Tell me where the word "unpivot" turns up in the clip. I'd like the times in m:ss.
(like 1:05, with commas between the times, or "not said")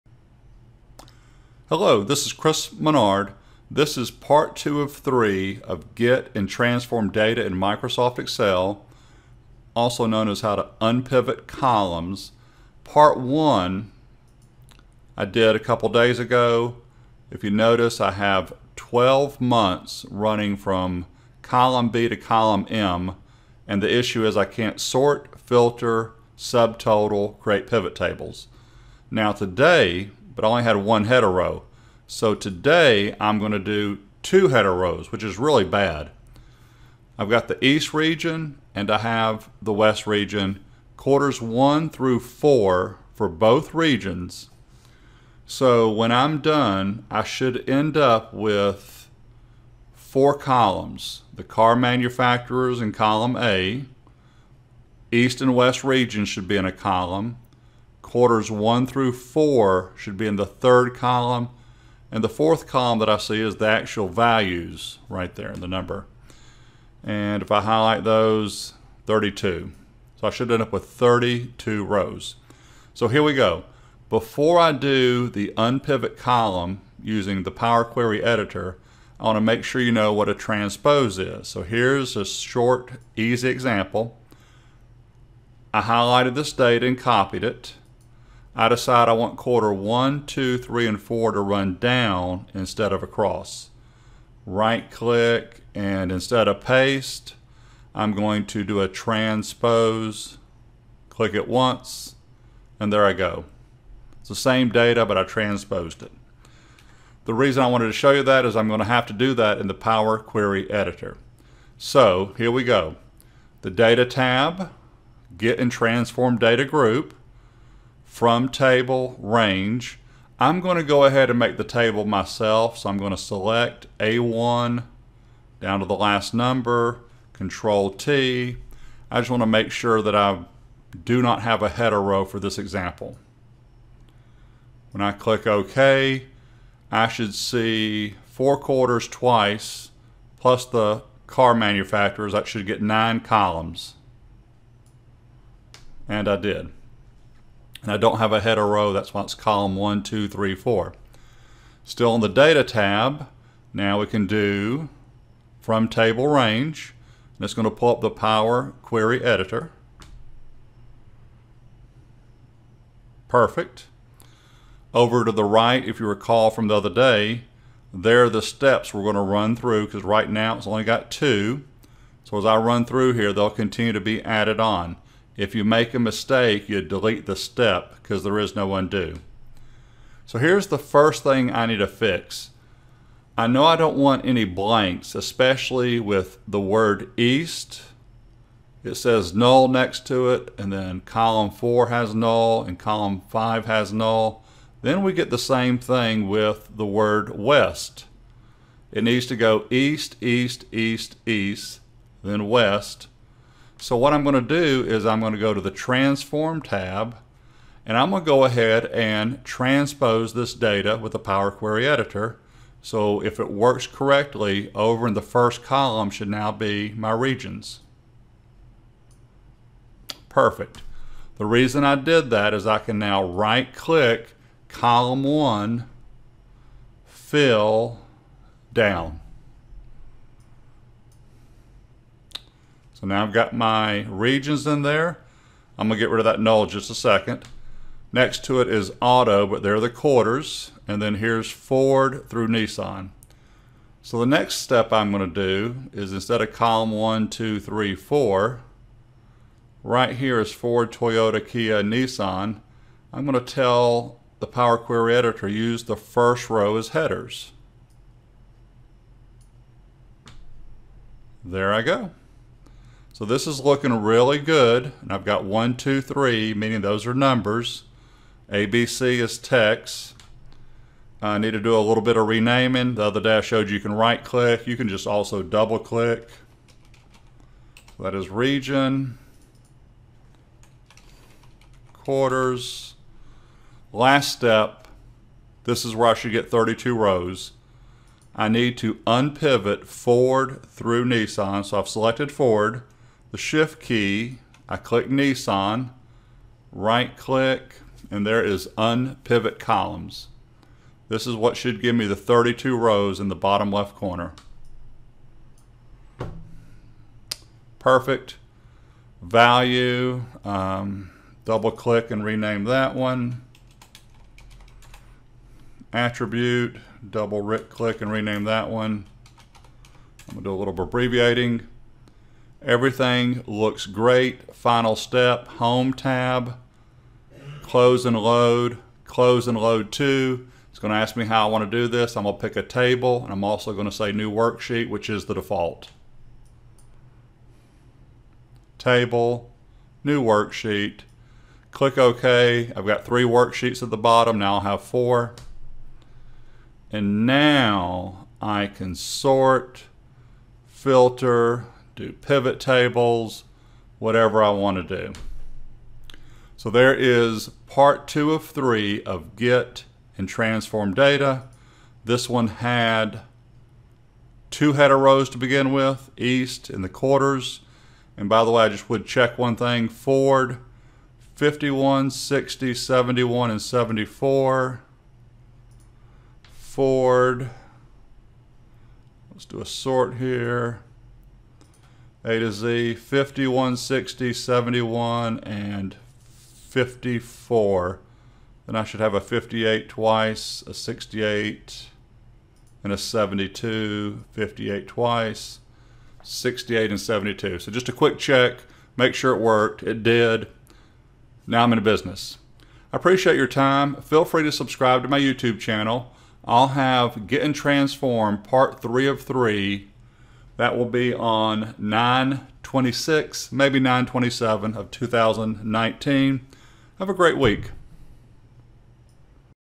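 0:10, 1:15, 4:49, 4:58.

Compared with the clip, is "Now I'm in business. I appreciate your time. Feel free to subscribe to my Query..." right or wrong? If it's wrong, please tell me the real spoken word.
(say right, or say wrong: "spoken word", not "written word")
wrong: "YouTube", not "Query".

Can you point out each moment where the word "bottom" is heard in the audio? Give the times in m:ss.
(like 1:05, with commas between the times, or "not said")
5:03, 5:43.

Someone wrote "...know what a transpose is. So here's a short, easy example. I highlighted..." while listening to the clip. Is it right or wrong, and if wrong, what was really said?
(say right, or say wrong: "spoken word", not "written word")
right.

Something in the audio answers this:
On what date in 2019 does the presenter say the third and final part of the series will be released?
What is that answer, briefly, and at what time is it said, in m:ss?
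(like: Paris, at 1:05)
9/26, at 6:51.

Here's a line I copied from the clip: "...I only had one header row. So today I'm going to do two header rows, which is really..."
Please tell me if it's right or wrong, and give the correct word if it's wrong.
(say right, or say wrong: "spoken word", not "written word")
right.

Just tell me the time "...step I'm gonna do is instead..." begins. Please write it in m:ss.
4:04.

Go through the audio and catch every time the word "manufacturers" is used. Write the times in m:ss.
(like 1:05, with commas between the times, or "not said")
0:51, 2:21.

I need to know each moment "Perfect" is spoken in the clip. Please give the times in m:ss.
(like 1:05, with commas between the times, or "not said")
2:43, 3:40, 5:07.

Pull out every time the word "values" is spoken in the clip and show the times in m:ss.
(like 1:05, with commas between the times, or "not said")
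1:04, 5:09.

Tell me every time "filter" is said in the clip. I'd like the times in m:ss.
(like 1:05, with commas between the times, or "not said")
0:25, 5:50.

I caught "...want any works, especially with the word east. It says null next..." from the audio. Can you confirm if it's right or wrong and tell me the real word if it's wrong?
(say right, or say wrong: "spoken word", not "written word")
wrong: "blanks", not "works".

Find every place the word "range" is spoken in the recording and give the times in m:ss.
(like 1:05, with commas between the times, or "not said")
1:59, 2:36.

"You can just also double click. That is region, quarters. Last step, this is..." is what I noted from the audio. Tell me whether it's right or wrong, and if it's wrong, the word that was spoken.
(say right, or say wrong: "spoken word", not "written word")
right.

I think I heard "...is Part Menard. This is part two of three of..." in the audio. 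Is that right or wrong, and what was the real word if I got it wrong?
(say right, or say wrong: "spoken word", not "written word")
wrong: "Chris", not "Part".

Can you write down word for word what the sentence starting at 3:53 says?
So now I've got my regions in there.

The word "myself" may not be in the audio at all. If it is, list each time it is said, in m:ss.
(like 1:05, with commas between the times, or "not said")
2:02.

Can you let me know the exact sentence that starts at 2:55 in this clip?
If you make a mistake, you delete the step because there is no undo.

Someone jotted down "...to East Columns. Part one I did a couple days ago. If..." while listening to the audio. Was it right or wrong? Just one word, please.
wrong.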